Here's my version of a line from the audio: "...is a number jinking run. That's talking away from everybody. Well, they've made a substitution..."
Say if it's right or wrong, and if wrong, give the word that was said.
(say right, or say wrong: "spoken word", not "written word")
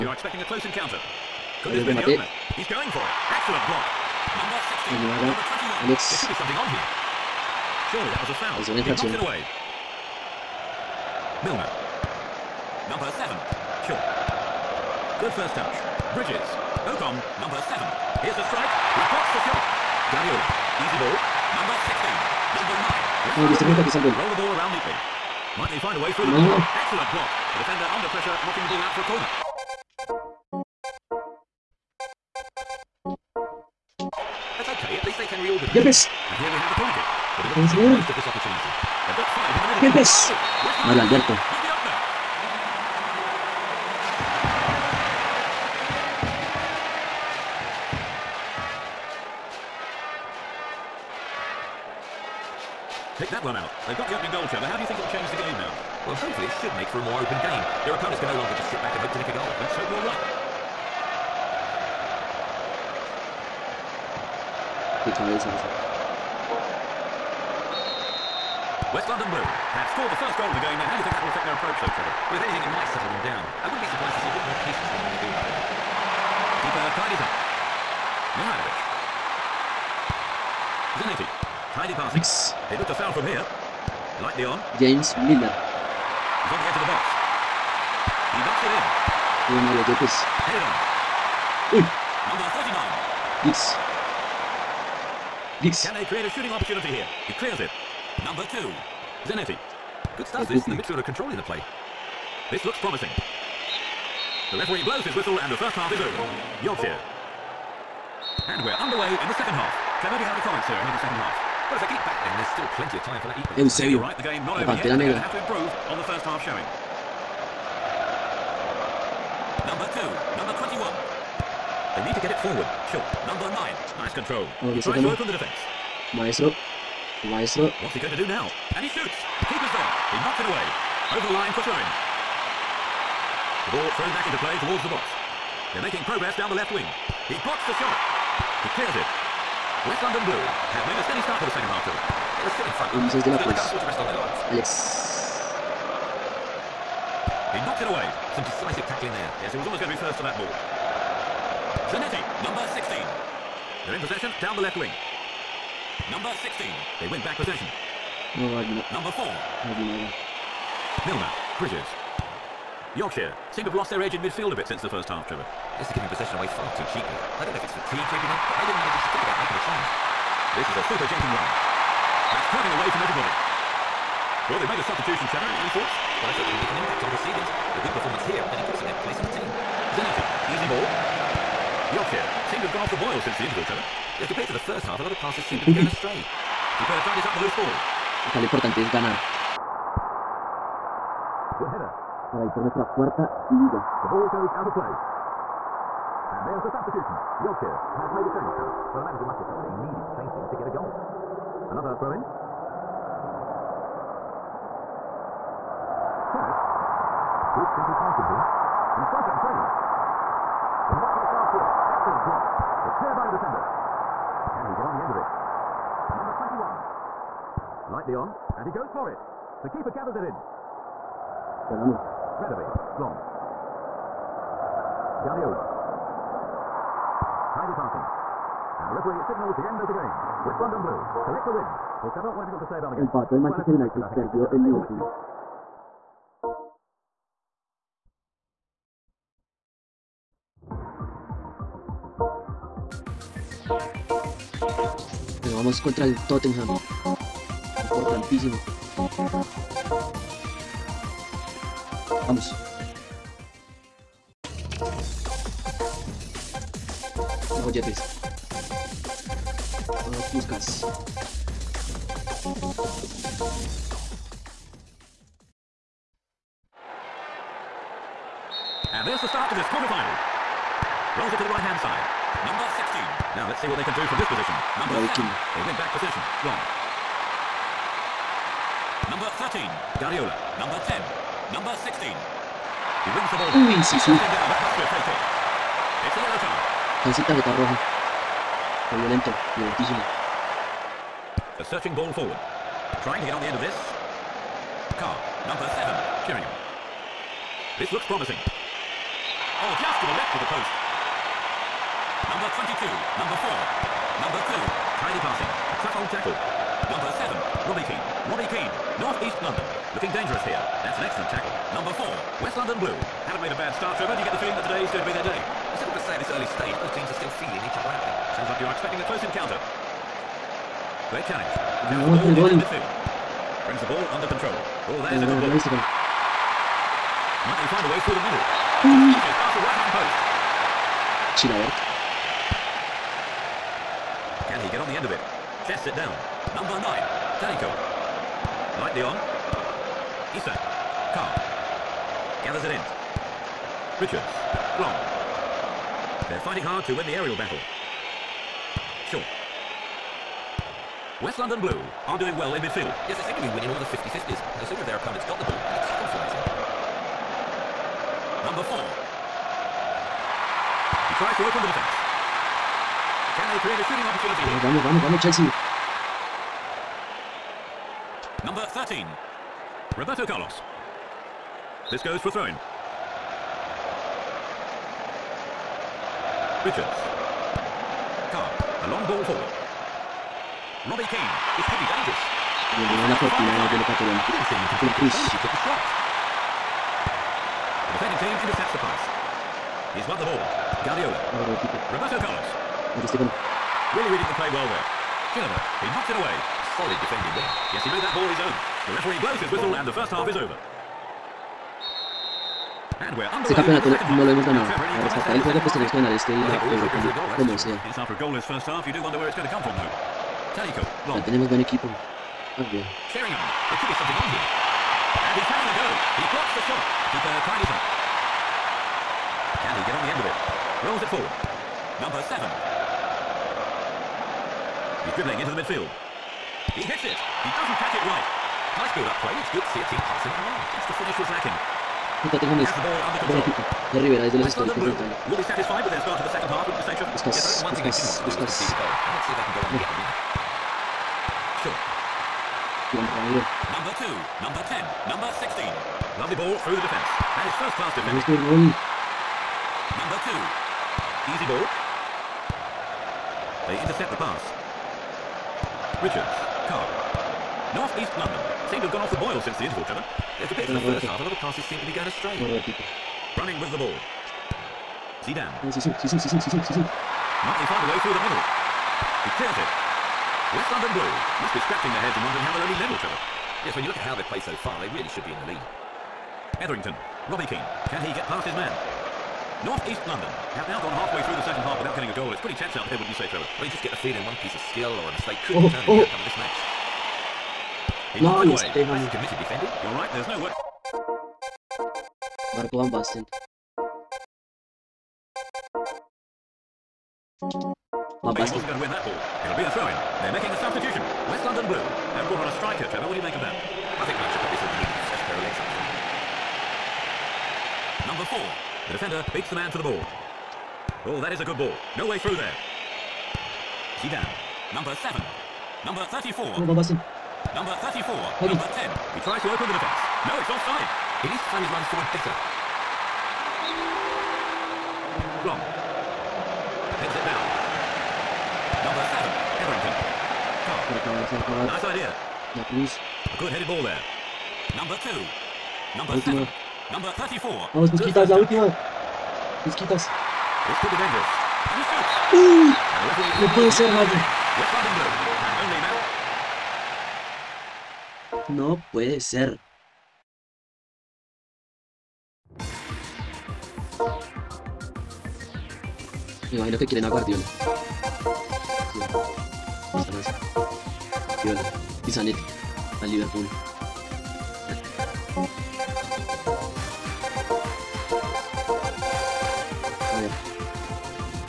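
wrong: "super", not "number".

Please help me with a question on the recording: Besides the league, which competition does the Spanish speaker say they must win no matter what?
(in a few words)
Europa.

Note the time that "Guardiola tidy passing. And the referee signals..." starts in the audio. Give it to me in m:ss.
3:45.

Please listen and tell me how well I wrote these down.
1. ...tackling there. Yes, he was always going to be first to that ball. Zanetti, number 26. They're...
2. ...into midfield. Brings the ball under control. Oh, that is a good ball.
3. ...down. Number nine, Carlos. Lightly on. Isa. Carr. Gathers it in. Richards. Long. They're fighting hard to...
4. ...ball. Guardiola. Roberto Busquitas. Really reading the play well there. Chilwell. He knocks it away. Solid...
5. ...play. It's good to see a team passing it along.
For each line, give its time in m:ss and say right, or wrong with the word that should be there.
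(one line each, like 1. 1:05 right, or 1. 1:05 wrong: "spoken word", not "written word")
1. 2:28 wrong: "16", not "26"
2. 5:22 right
3. 5:35 wrong: "Tanico", not "Carlos"
4. 6:30 wrong: "Carlos", not "Busquitas"
5. 7:09 right.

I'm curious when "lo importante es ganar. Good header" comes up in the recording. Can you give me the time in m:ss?
3:08.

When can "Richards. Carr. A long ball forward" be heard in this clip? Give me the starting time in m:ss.
6:16.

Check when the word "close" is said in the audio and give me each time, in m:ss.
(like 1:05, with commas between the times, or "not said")
0:00, 5:19.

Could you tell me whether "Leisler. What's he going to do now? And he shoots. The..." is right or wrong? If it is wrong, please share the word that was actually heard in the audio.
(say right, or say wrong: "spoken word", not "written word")
right.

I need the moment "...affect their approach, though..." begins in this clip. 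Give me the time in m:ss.
1:11.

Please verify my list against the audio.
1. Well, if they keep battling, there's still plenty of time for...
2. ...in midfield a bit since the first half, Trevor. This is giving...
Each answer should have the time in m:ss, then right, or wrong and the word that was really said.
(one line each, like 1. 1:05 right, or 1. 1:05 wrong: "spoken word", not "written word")
1. 1:51 right
2. 2:44 right.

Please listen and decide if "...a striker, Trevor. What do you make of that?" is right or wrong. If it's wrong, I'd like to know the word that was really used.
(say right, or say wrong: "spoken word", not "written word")
right.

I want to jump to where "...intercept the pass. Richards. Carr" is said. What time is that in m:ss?
7:33.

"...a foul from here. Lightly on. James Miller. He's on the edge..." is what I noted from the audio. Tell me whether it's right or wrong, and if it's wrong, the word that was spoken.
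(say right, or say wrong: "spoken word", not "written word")
right.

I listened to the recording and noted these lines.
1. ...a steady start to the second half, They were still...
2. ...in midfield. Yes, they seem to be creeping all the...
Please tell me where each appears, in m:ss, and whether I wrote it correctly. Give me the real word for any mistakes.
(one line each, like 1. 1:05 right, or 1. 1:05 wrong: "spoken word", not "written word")
1. 2:20 right
2. 5:52 wrong: "winning", not "creeping".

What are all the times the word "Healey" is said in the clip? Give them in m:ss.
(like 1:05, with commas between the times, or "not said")
not said.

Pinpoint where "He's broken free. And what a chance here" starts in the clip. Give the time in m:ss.
3:28.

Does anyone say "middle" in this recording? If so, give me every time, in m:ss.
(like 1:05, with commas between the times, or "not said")
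5:28, 7:48.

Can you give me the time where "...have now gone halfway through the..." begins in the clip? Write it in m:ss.
8:00.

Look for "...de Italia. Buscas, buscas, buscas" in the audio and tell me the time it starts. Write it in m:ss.
7:14.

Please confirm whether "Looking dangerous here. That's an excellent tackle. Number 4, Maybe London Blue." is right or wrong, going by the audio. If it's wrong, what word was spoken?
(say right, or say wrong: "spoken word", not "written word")
wrong: "West", not "Maybe".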